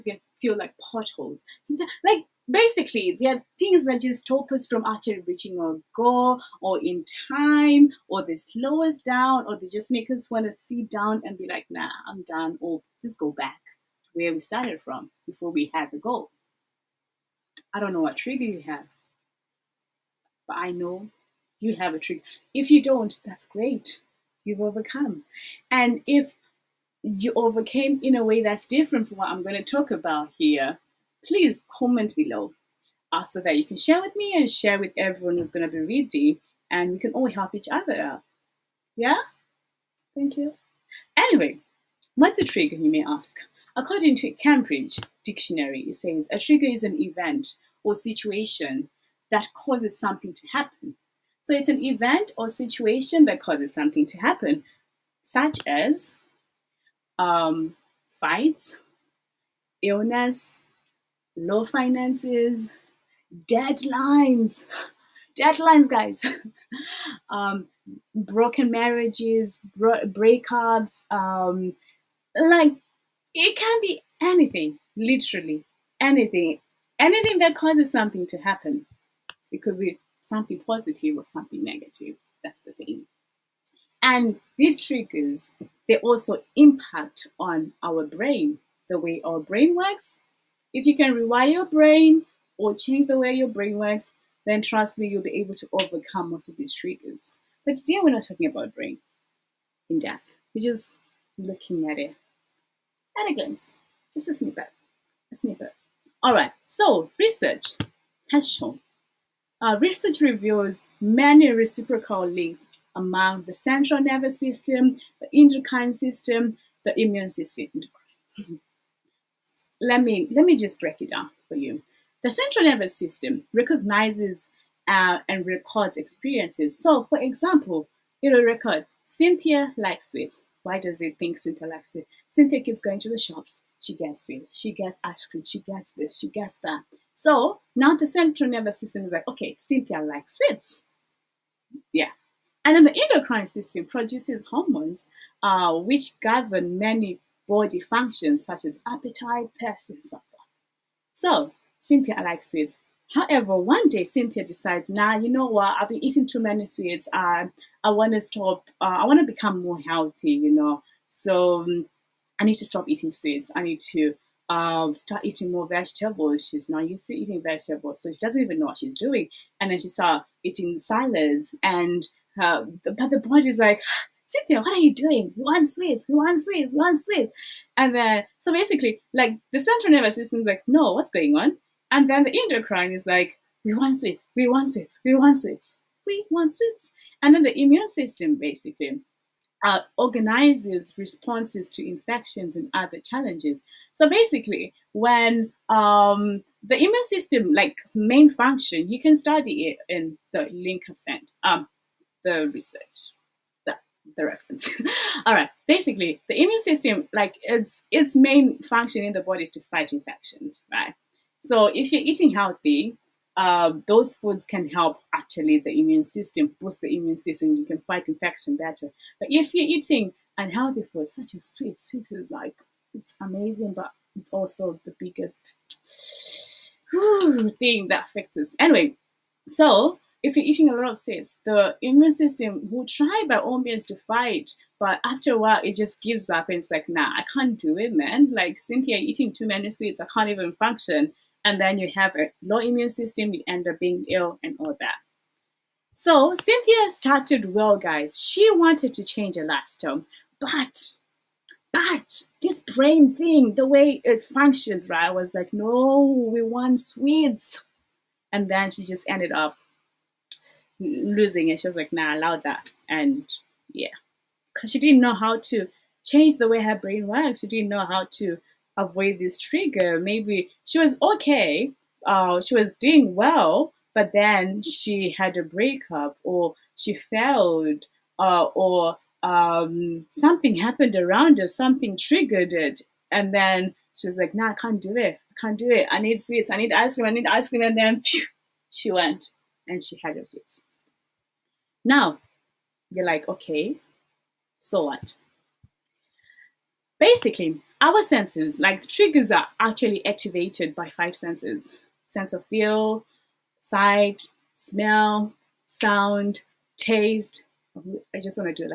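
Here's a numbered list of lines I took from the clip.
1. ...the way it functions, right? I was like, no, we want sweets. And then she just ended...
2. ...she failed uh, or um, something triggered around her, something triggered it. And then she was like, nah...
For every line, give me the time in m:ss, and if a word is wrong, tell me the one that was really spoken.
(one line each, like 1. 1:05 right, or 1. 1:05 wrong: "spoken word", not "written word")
1. 4:13 right
2. 4:36 wrong: "happened", not "triggered".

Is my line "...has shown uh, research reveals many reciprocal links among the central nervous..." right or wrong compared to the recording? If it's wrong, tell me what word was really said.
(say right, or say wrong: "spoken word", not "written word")
right.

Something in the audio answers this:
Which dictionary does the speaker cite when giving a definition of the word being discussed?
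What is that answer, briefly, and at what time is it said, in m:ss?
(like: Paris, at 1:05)
Cambridge Dictionary, at 0:44.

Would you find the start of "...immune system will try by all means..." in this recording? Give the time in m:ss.
3:51.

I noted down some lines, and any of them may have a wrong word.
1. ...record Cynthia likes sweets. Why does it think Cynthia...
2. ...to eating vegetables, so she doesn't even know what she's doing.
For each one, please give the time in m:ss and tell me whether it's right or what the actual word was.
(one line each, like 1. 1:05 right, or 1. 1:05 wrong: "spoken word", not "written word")
1. 2:08 right
2. 2:47 right.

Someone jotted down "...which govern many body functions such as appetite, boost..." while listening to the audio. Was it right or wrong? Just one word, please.
wrong.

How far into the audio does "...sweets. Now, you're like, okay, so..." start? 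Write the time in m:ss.
4:50.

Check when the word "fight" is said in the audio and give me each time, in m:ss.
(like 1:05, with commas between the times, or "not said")
0:58, 3:29, 3:37, 3:53.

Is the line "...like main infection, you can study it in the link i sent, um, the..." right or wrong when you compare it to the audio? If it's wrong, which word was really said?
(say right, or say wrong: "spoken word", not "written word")
wrong: "function", not "infection".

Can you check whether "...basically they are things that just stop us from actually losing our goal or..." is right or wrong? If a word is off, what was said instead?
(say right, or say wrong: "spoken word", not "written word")
wrong: "reaching", not "losing".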